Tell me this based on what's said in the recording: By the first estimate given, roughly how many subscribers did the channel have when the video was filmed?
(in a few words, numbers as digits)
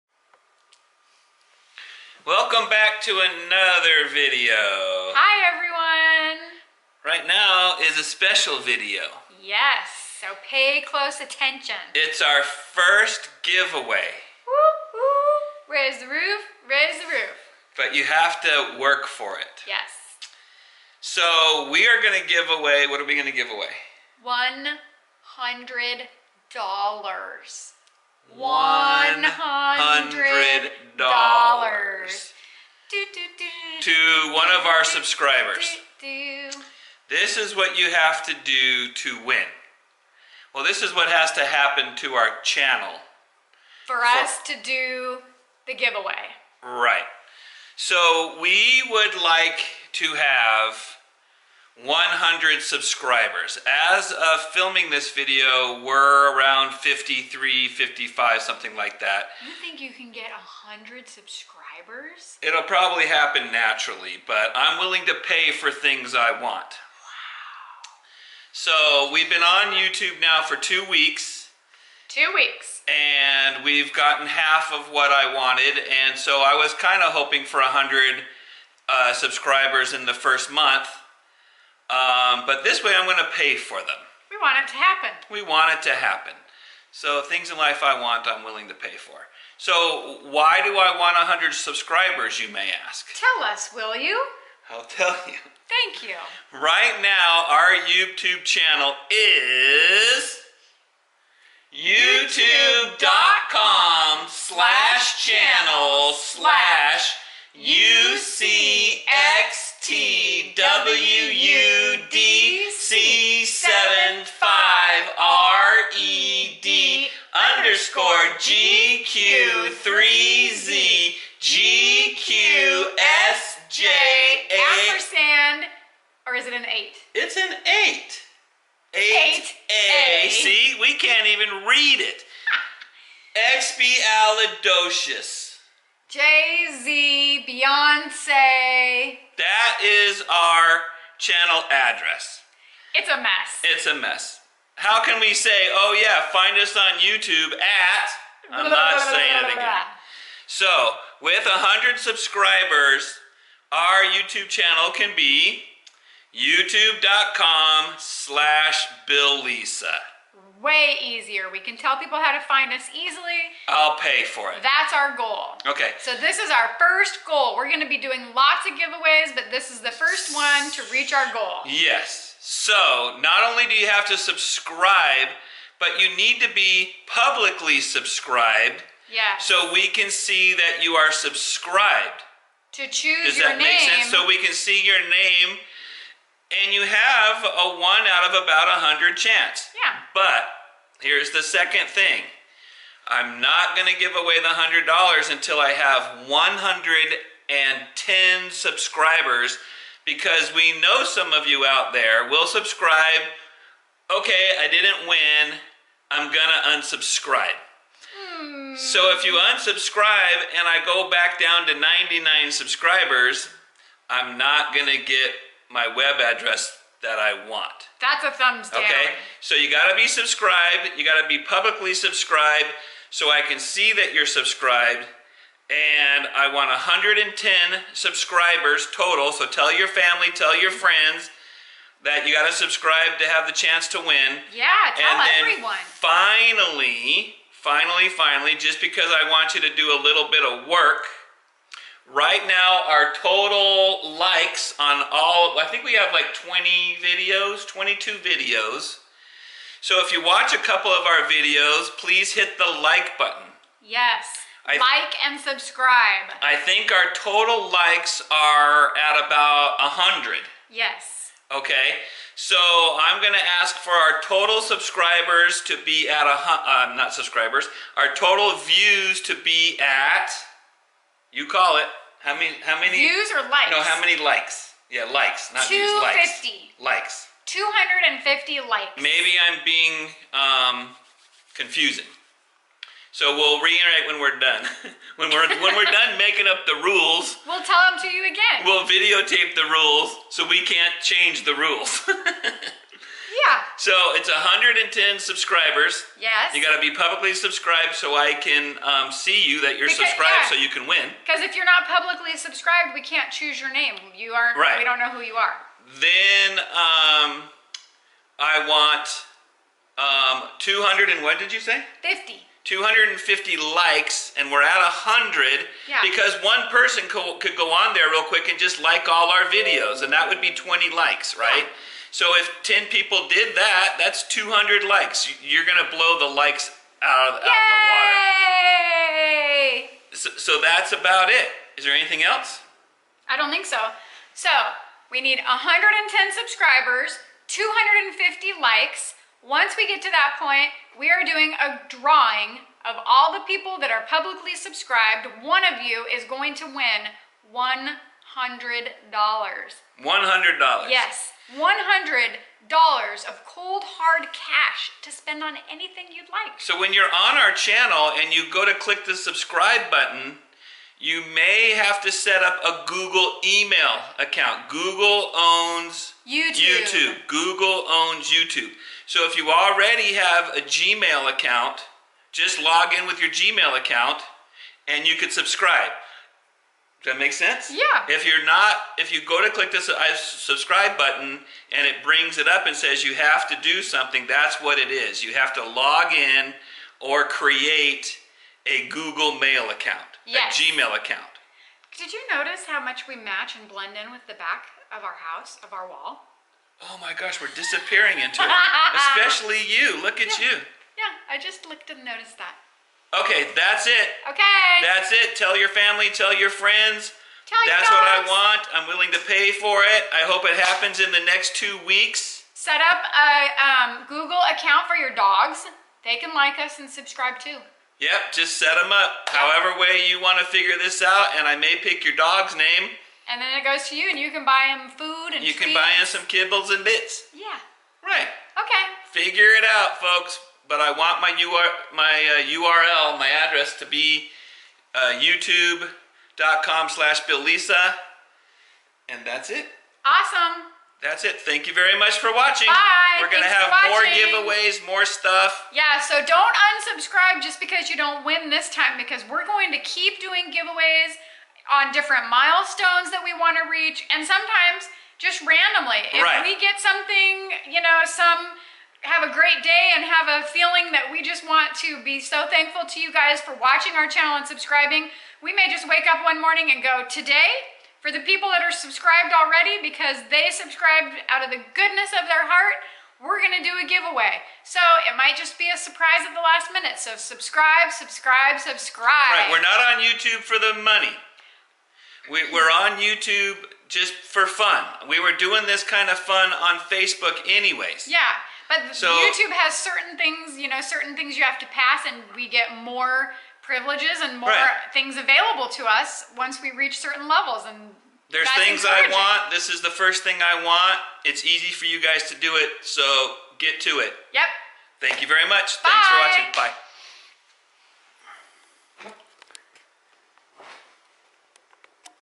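53.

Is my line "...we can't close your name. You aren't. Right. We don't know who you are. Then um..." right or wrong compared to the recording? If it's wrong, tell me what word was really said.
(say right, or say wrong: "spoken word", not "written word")
wrong: "choose", not "close".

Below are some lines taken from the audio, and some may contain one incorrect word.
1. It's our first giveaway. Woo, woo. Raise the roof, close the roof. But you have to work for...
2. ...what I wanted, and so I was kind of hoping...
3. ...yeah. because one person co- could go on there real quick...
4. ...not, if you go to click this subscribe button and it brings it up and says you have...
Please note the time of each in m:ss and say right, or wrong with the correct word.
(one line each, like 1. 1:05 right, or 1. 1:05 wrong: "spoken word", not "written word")
1. 0:11 wrong: "raise", not "close"
2. 1:14 right
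3. 5:15 right
4. 6:18 right.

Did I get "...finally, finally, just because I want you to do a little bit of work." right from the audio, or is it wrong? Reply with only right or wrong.
right.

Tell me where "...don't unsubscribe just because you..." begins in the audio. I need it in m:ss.
7:26.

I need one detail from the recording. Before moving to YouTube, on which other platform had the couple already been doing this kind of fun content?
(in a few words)
Facebook.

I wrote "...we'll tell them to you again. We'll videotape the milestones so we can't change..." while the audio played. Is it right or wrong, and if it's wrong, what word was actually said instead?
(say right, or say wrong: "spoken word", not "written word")
wrong: "rules", not "milestones".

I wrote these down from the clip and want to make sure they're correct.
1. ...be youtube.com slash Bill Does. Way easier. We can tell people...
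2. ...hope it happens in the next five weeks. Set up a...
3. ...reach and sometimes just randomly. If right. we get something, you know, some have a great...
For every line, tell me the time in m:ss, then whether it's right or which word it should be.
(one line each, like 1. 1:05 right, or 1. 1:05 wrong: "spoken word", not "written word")
1. 2:35 wrong: "Lisa", not "Does"
2. 6:50 wrong: "two", not "five"
3. 7:33 right.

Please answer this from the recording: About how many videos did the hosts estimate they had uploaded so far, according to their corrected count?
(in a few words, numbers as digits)
22.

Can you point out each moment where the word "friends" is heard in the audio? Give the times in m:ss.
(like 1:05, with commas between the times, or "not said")
3:50, 6:46.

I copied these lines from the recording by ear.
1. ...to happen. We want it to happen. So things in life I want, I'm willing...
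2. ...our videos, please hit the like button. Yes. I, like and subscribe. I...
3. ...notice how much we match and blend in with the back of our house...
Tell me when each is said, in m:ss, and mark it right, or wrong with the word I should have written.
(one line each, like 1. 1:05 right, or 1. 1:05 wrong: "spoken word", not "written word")
1. 1:24 right
2. 4:11 right
3. 6:32 right.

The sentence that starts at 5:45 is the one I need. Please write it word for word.
One of you is going to win $100.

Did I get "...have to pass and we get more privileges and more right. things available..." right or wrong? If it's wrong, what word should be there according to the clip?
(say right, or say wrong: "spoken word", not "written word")
right.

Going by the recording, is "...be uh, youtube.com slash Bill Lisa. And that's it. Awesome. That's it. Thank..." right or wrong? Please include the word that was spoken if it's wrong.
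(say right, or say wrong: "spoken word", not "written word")
right.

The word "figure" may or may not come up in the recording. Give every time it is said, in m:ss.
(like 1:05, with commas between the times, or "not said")
7:00, 7:09.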